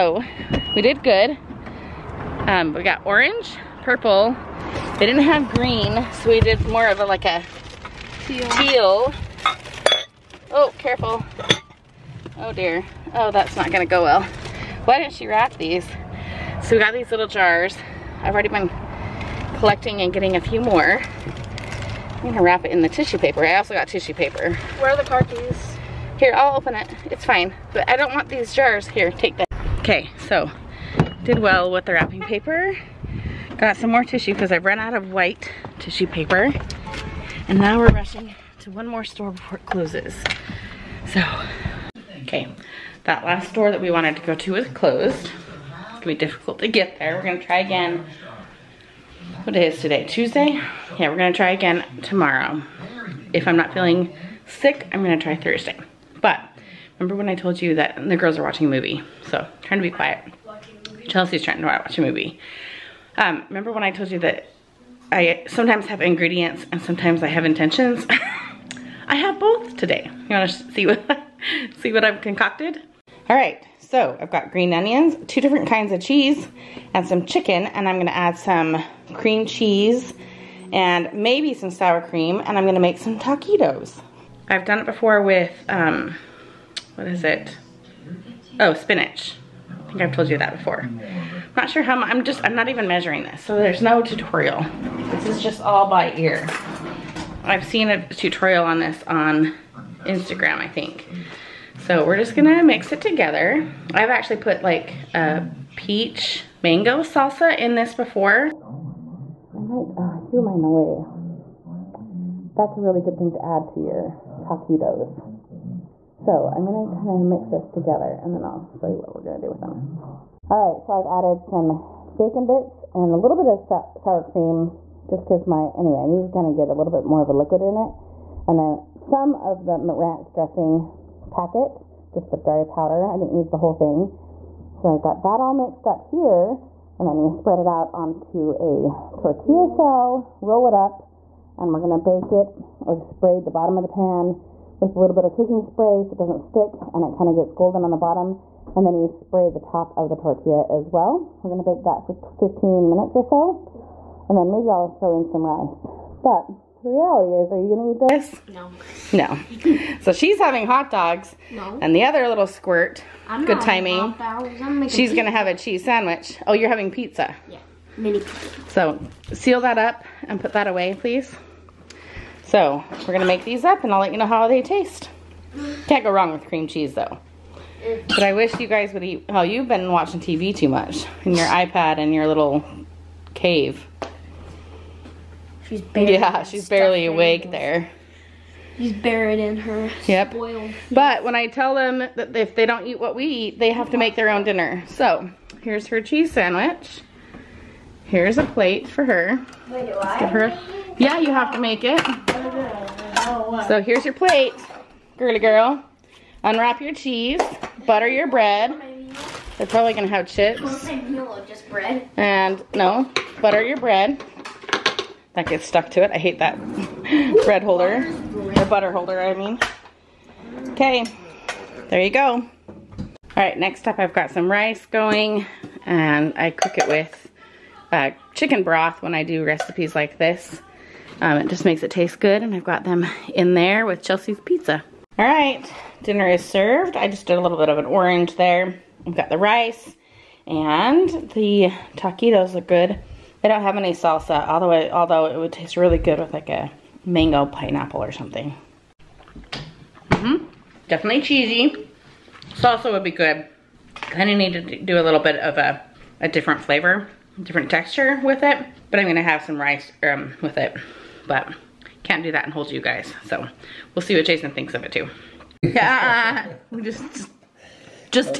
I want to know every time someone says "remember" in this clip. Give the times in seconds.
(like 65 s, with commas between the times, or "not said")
56 s, 63 s.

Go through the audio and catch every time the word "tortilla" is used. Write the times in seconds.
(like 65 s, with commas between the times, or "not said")
139 s, 150 s.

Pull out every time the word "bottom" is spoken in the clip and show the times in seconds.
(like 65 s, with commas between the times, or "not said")
143 s, 147 s.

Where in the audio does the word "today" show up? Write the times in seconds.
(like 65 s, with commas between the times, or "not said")
49 s, 69 s.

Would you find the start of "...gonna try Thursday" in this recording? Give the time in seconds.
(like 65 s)
55 s.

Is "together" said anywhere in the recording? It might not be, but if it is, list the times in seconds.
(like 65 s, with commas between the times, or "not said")
103 s, 117 s.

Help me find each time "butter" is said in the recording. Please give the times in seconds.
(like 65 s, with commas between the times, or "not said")
207 s, 213 s, 218 s.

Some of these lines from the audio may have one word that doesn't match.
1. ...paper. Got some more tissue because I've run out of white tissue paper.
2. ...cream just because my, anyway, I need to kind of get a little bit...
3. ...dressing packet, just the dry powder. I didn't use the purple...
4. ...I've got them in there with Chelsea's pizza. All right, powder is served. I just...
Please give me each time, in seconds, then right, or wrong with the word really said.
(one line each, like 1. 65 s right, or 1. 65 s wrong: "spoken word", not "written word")
1. 32 s right
2. 124 s right
3. 130 s wrong: "whole", not "purple"
4. 232 s wrong: "dinner", not "powder".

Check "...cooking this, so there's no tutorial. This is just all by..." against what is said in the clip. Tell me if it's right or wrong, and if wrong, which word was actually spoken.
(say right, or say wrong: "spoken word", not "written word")
wrong: "measuring", not "cooking".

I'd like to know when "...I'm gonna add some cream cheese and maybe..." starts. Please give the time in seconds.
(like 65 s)
77 s.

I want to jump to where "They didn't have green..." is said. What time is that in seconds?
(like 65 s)
4 s.